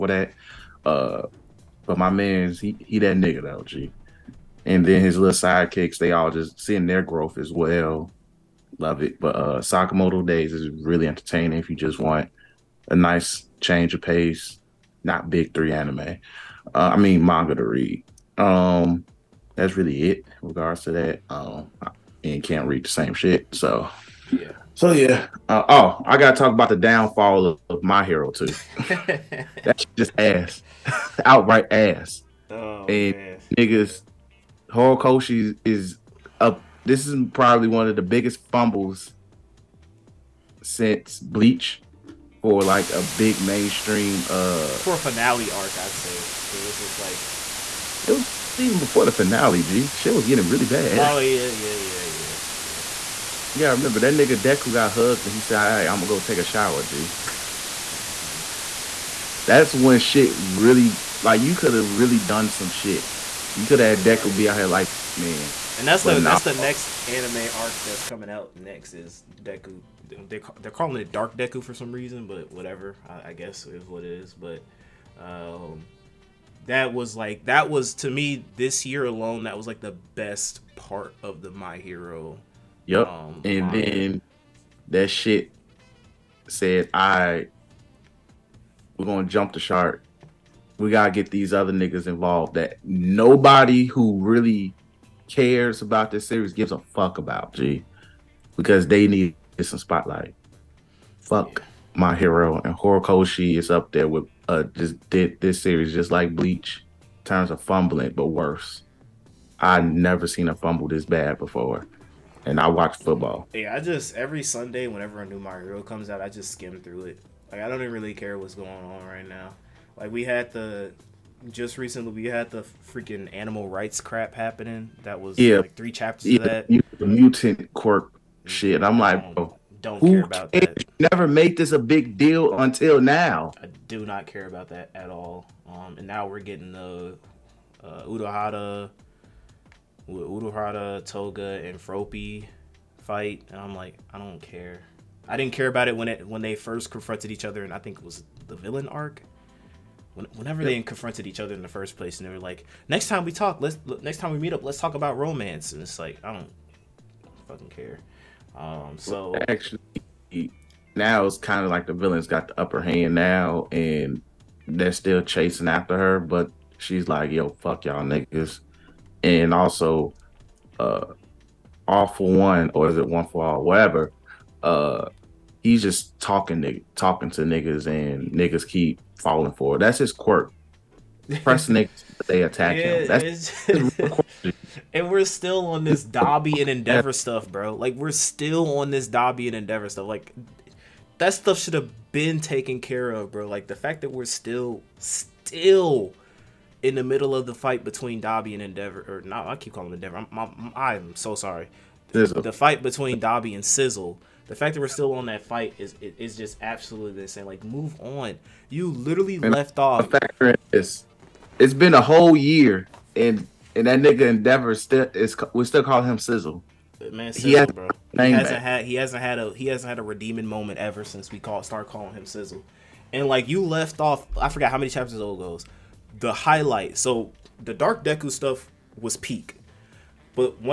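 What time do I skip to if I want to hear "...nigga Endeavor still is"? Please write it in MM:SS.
03:34.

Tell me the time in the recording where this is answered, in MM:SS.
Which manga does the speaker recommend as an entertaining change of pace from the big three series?
00:09.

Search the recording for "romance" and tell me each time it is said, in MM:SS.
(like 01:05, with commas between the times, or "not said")
02:35.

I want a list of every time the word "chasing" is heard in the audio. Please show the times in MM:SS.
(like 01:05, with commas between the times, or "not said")
02:45.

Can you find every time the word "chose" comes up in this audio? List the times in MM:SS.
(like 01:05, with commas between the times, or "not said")
not said.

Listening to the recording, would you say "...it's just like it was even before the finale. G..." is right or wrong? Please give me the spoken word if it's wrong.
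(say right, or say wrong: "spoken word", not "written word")
right.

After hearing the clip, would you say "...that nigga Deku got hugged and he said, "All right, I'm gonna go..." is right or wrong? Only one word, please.
right.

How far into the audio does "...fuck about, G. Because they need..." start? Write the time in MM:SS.
01:36.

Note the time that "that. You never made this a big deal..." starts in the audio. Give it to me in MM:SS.
02:10.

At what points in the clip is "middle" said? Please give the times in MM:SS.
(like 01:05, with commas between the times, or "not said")
03:17.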